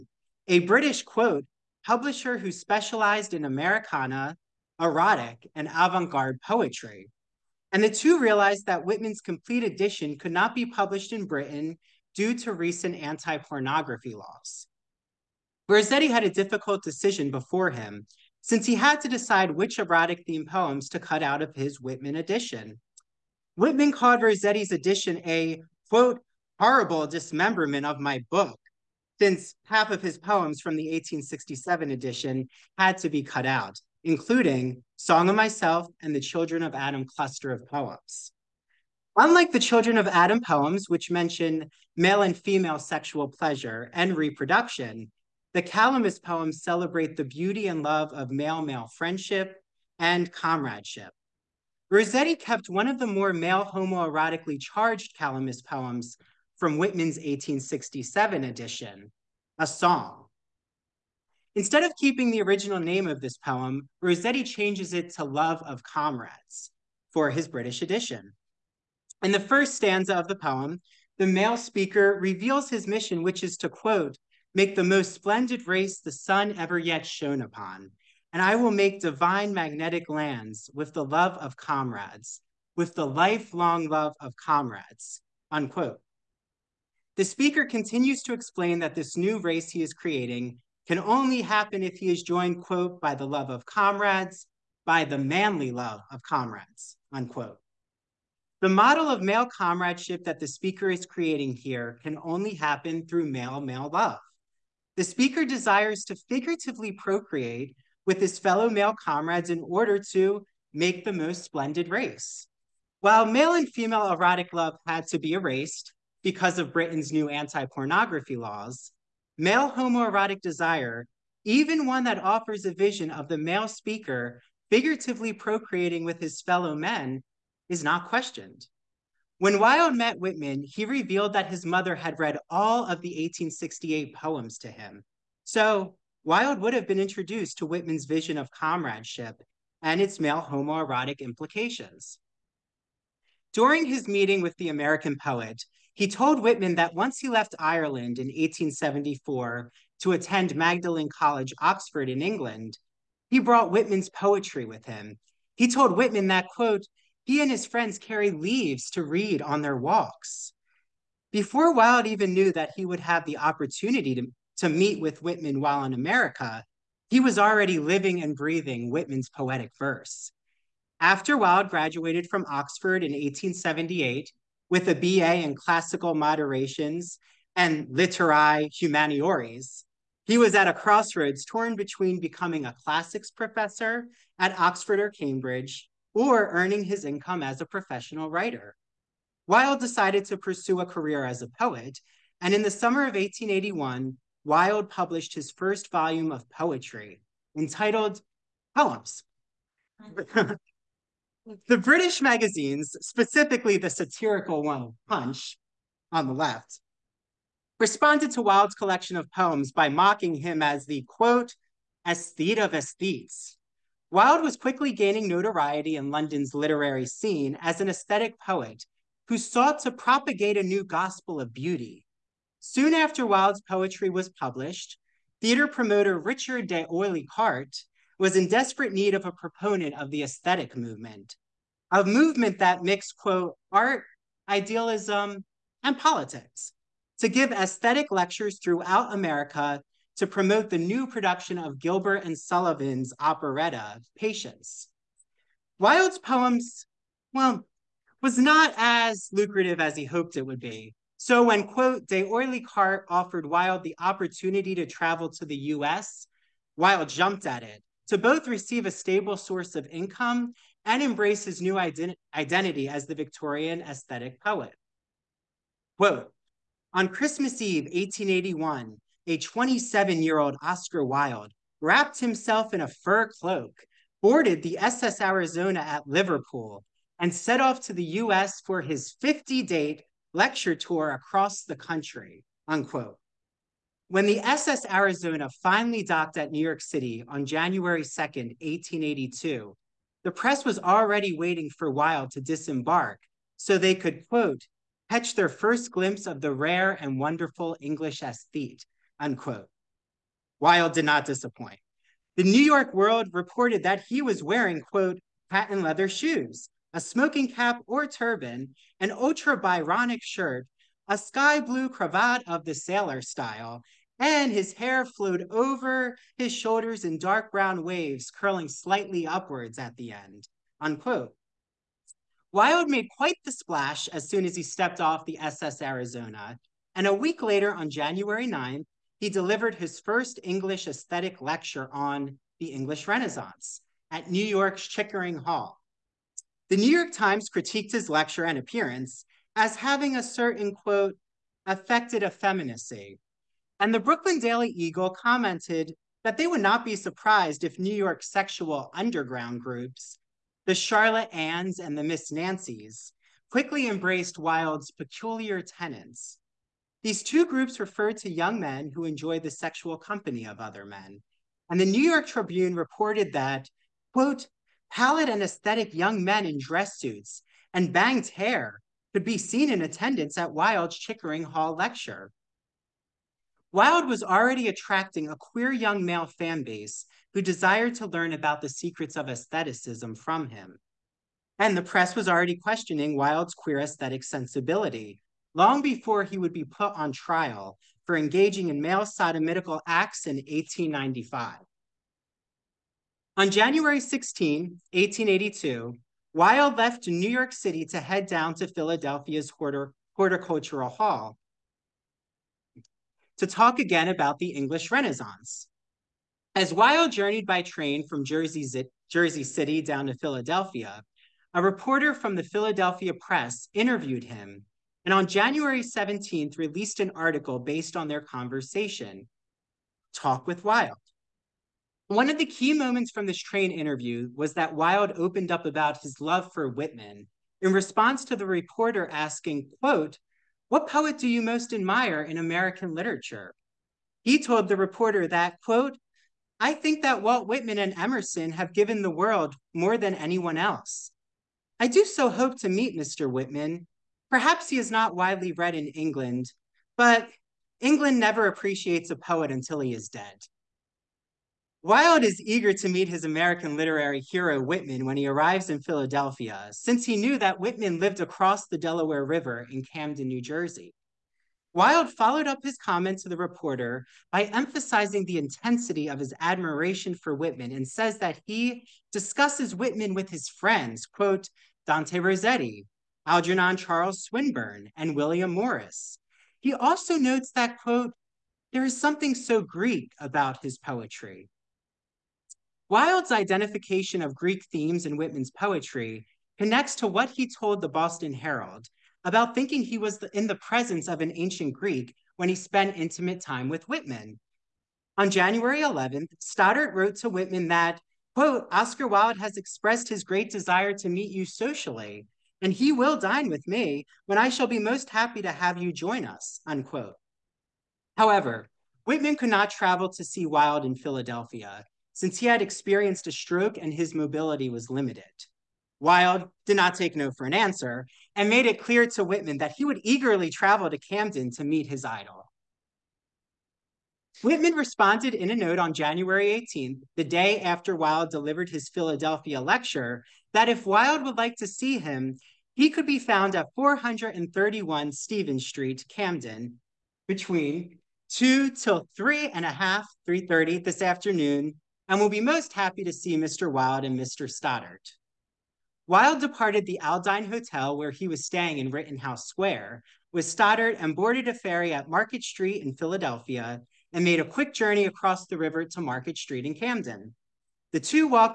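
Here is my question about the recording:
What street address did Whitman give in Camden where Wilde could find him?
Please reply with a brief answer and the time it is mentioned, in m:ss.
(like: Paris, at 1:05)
431 Stephen Street, at 8:53.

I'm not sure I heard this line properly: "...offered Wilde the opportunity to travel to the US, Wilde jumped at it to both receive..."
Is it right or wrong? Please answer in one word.
right.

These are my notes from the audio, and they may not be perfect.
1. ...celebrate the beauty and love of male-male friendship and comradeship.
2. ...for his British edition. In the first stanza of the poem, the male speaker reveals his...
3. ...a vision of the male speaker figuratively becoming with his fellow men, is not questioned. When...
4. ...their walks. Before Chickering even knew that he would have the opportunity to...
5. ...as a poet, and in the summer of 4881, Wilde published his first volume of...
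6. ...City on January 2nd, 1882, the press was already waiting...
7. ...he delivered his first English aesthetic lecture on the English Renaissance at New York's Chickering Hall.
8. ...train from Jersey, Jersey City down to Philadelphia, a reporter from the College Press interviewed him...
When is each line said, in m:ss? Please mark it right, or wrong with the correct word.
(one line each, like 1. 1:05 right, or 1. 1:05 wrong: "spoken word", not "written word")
1. 0:46 right
2. 1:07 right
3. 2:02 wrong: "procreating", not "becoming"
4. 2:39 wrong: "Wilde", not "Chickering"
5. 3:11 wrong: "1881", not "4881"
6. 4:46 right
7. 5:29 right
8. 6:47 wrong: "Philadelphia", not "College".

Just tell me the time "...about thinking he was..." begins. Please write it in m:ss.
8:09.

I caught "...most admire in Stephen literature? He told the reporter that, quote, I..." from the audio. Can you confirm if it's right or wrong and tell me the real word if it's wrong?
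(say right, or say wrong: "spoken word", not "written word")
wrong: "American", not "Stephen".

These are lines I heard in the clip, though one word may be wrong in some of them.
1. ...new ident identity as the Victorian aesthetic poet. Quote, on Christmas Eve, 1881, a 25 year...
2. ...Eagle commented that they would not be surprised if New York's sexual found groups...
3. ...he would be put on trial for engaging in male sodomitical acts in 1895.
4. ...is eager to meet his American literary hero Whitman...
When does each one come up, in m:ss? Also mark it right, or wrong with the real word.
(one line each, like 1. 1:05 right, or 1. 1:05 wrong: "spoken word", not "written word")
1. 4:21 wrong: "27", not "25"
2. 5:44 wrong: "underground", not "found"
3. 6:26 right
4. 7:32 right.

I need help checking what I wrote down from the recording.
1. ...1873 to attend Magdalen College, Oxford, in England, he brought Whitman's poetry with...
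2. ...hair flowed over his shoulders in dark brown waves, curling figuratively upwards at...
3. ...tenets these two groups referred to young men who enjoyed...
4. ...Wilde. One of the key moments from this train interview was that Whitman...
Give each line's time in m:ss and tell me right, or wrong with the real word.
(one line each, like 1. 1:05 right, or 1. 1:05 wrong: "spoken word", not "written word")
1. 2:28 wrong: "1874", not "1873"
2. 5:14 wrong: "slightly", not "figuratively"
3. 5:55 right
4. 7:00 wrong: "Wilde", not "Whitman".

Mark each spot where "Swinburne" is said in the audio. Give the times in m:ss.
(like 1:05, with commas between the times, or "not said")
7:54.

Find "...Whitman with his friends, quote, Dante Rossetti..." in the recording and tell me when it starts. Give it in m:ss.
7:49.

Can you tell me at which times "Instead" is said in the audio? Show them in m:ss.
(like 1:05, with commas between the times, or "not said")
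1:01.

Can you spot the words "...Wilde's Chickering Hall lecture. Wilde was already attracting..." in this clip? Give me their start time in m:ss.
6:10.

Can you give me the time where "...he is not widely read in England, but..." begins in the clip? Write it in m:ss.
7:24.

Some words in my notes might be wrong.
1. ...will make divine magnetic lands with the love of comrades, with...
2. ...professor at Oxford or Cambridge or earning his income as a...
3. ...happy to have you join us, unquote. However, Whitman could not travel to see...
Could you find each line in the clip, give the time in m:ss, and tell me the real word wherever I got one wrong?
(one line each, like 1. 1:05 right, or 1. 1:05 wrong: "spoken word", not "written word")
1. 1:18 right
2. 3:03 right
3. 8:25 right.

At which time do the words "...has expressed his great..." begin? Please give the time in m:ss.
8:19.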